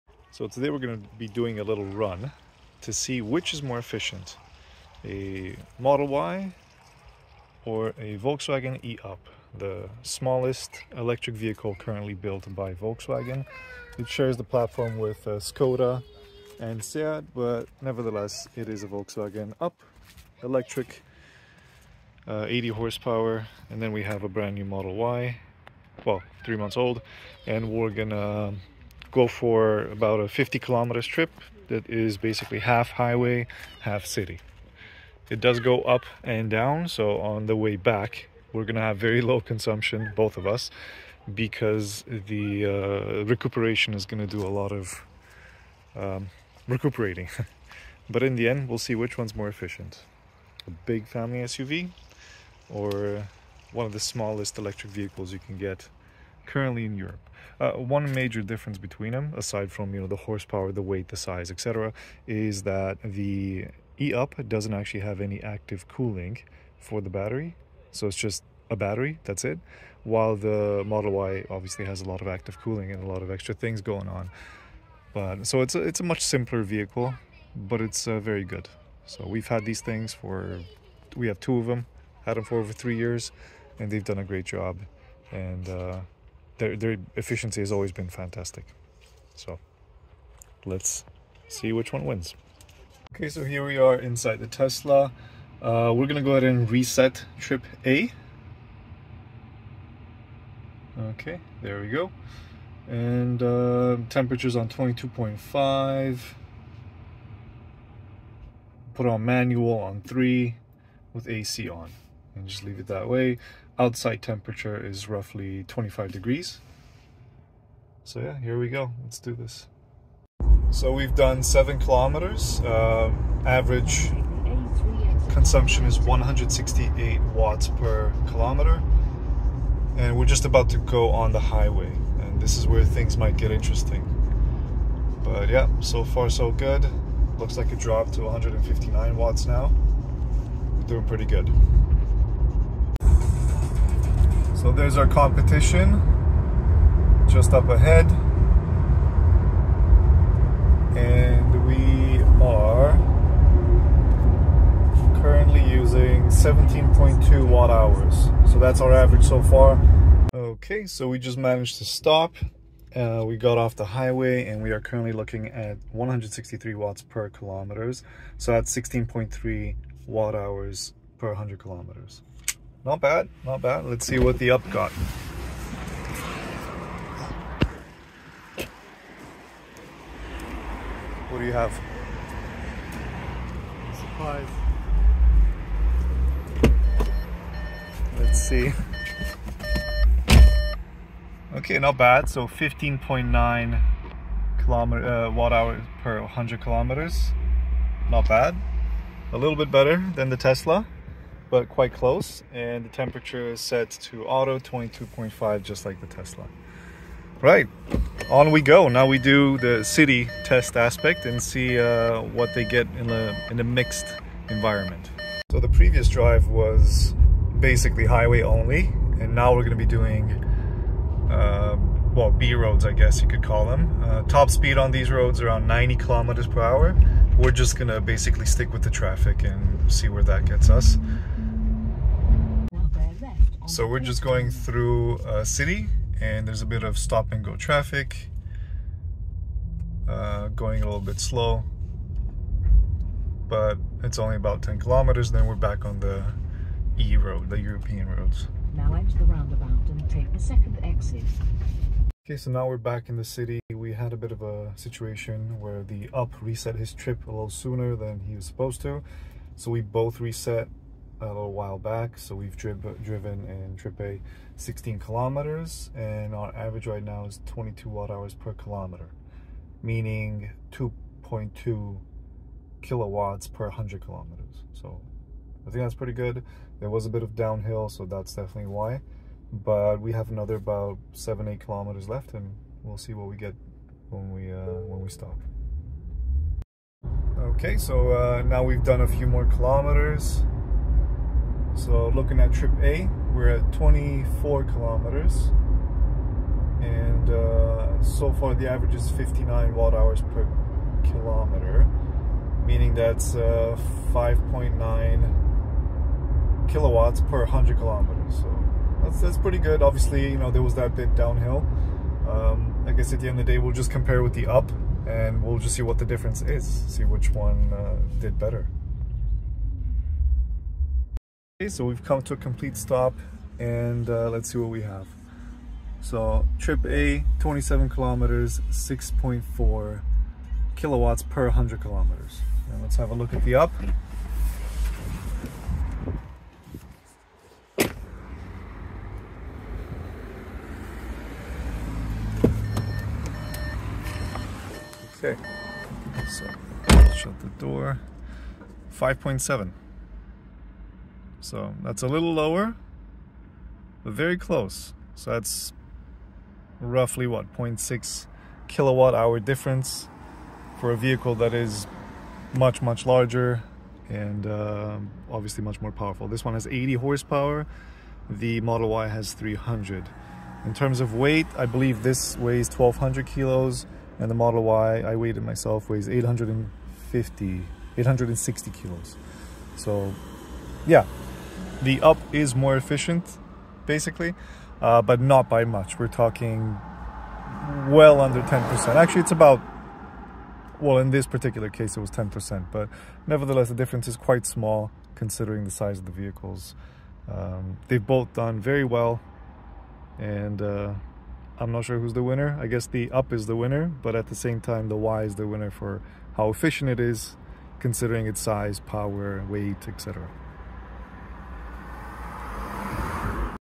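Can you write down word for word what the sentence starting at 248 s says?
Now enter the roundabout and take the second exit.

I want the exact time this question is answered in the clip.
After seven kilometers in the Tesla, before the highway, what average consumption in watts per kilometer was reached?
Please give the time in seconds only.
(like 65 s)
125 s.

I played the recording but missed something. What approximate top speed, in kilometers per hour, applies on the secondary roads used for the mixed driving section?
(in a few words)
90 kilometers per hour.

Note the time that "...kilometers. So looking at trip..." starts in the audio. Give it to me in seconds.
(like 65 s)
289 s.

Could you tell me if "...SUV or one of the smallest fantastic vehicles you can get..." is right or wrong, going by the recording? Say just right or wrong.
wrong.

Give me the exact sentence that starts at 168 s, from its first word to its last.
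So that's 16.3 watt hours per 100 kilometers.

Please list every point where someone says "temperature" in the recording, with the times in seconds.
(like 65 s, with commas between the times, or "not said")
104 s, 114 s, 202 s.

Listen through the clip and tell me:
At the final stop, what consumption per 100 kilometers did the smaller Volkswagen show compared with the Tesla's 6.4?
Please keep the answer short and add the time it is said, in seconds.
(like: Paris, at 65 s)
5.7, at 348 s.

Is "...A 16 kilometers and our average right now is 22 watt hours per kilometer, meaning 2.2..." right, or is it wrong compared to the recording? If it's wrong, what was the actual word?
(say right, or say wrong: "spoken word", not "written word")
right.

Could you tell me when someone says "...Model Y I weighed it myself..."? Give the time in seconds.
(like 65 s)
374 s.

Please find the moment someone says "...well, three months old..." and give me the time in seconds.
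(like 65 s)
26 s.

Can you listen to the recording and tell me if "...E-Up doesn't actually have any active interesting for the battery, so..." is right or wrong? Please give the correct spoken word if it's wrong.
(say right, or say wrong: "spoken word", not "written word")
wrong: "cooling", not "interesting".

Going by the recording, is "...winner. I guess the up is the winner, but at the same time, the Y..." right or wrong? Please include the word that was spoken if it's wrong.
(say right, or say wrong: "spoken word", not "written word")
right.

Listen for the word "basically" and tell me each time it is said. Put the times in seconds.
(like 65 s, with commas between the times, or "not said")
32 s, 217 s, 227 s, 383 s.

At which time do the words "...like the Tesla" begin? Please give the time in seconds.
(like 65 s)
205 s.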